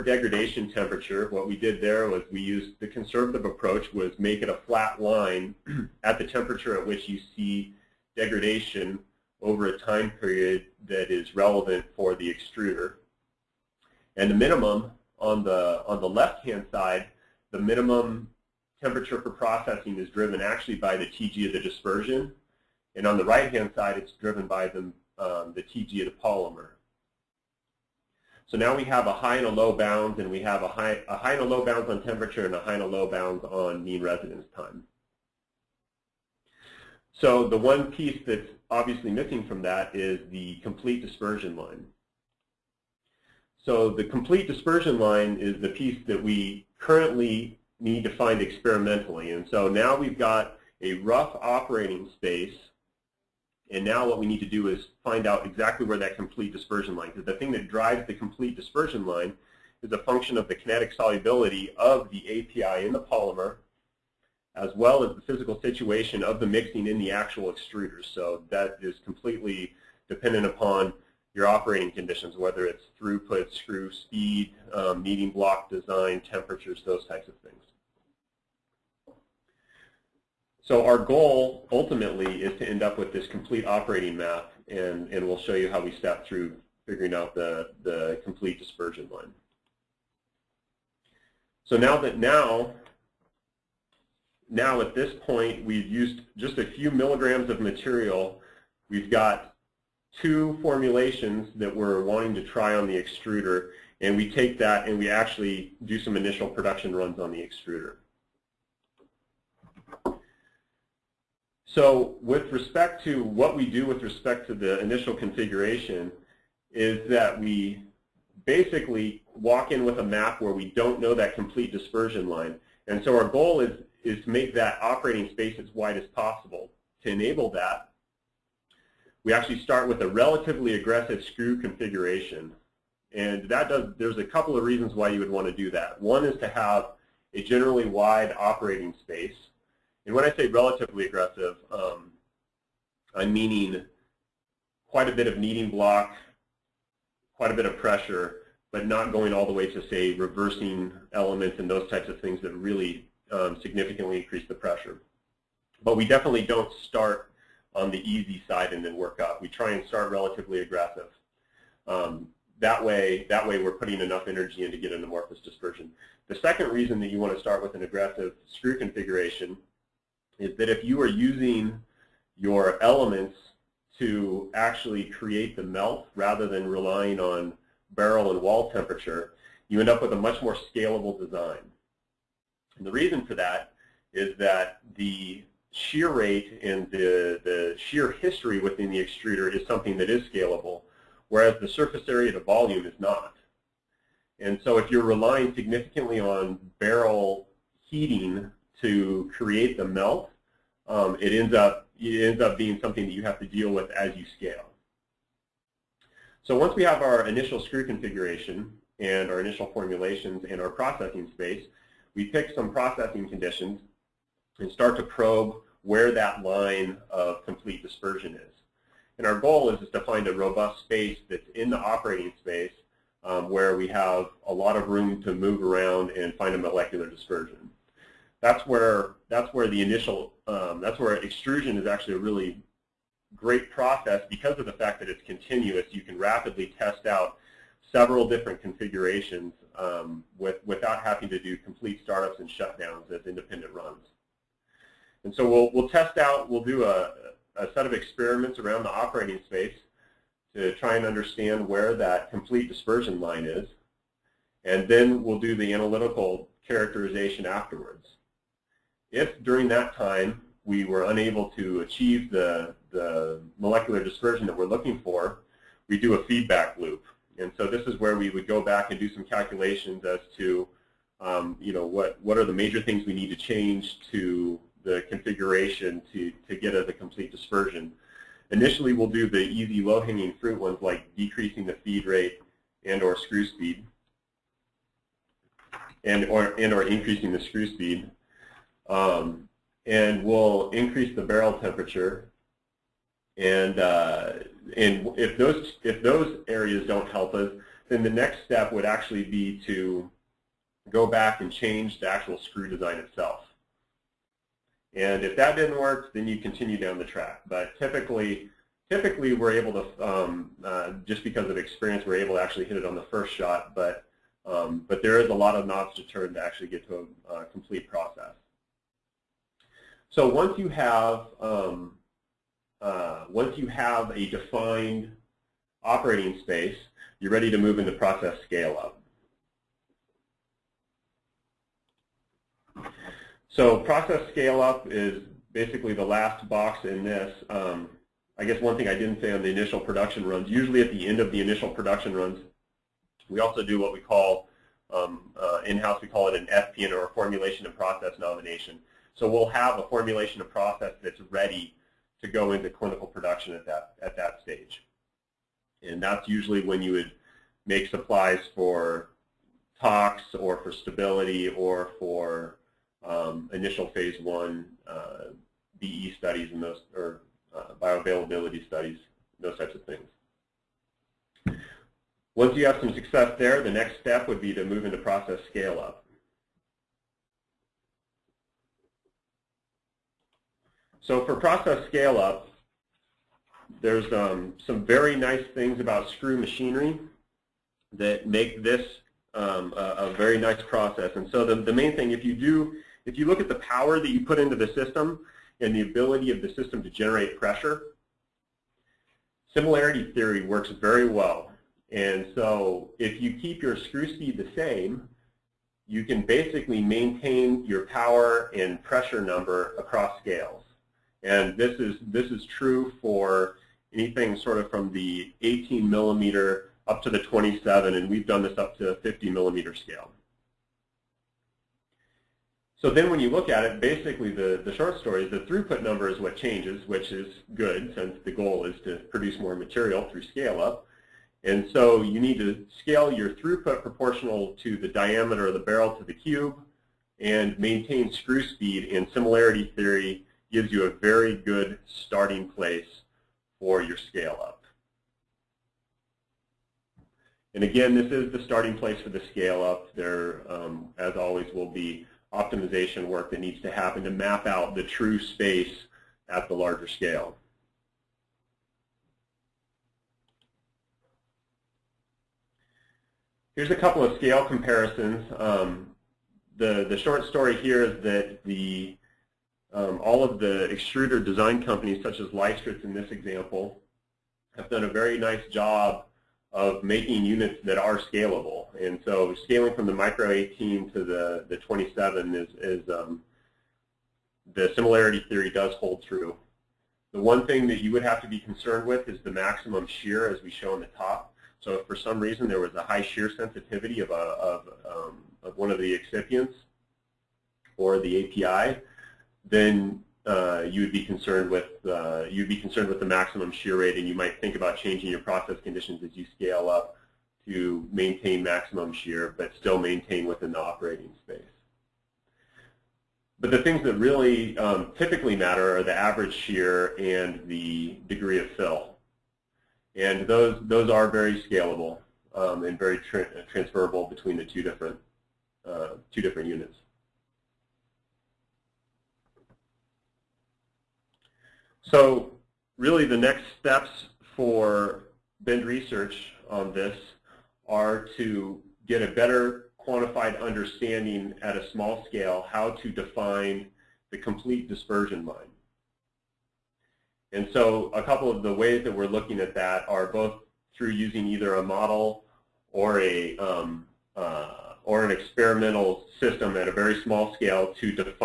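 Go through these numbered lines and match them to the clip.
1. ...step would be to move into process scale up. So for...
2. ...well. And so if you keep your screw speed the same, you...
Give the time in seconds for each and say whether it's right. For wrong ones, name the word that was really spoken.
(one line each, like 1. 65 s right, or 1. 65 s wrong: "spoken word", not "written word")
1. 373 s right
2. 401 s right.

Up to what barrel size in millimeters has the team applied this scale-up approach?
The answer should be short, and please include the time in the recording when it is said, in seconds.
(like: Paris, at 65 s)
50 millimeter, at 418 s.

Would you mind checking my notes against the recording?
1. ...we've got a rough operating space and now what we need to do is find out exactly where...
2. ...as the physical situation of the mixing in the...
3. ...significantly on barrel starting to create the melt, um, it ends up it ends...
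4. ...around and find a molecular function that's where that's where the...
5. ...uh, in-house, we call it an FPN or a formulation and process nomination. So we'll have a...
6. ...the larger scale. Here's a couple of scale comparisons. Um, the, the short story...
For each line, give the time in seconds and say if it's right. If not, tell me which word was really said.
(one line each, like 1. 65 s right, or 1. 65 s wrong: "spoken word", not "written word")
1. 49 s right
2. 65 s right
3. 195 s wrong: "heating", not "starting"
4. 225 s wrong: "dispersion", not "function"
5. 345 s right
6. 456 s right.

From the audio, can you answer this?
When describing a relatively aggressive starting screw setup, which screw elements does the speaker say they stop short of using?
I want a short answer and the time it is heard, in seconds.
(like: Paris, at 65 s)
reversing elements, at 150 s.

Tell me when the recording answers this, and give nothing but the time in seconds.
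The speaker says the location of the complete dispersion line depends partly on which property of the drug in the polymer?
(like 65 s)
60 s.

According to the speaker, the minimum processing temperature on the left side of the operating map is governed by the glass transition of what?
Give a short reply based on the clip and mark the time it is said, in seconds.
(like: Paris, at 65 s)
the dispersion, at 21 s.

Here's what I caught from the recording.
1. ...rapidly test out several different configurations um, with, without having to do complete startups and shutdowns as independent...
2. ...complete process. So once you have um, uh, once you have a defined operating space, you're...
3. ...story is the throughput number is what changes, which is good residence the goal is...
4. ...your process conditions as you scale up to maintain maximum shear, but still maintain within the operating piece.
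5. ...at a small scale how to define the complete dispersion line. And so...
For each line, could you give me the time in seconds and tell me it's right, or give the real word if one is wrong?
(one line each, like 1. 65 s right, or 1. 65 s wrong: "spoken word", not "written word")
1. 236 s right
2. 317 s right
3. 424 s wrong: "since", not "residence"
4. 505 s wrong: "space", not "piece"
5. 541 s right.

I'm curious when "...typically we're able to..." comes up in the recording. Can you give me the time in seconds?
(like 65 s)
308 s.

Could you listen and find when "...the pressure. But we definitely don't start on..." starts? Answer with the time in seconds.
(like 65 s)
154 s.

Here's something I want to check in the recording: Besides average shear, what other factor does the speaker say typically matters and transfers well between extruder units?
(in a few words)
degree of fill.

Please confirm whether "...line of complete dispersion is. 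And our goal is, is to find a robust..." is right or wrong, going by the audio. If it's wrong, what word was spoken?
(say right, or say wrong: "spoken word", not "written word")
right.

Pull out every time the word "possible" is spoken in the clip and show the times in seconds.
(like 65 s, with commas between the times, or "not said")
126 s.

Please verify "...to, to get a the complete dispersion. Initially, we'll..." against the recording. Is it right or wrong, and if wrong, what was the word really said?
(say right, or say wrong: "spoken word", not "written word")
right.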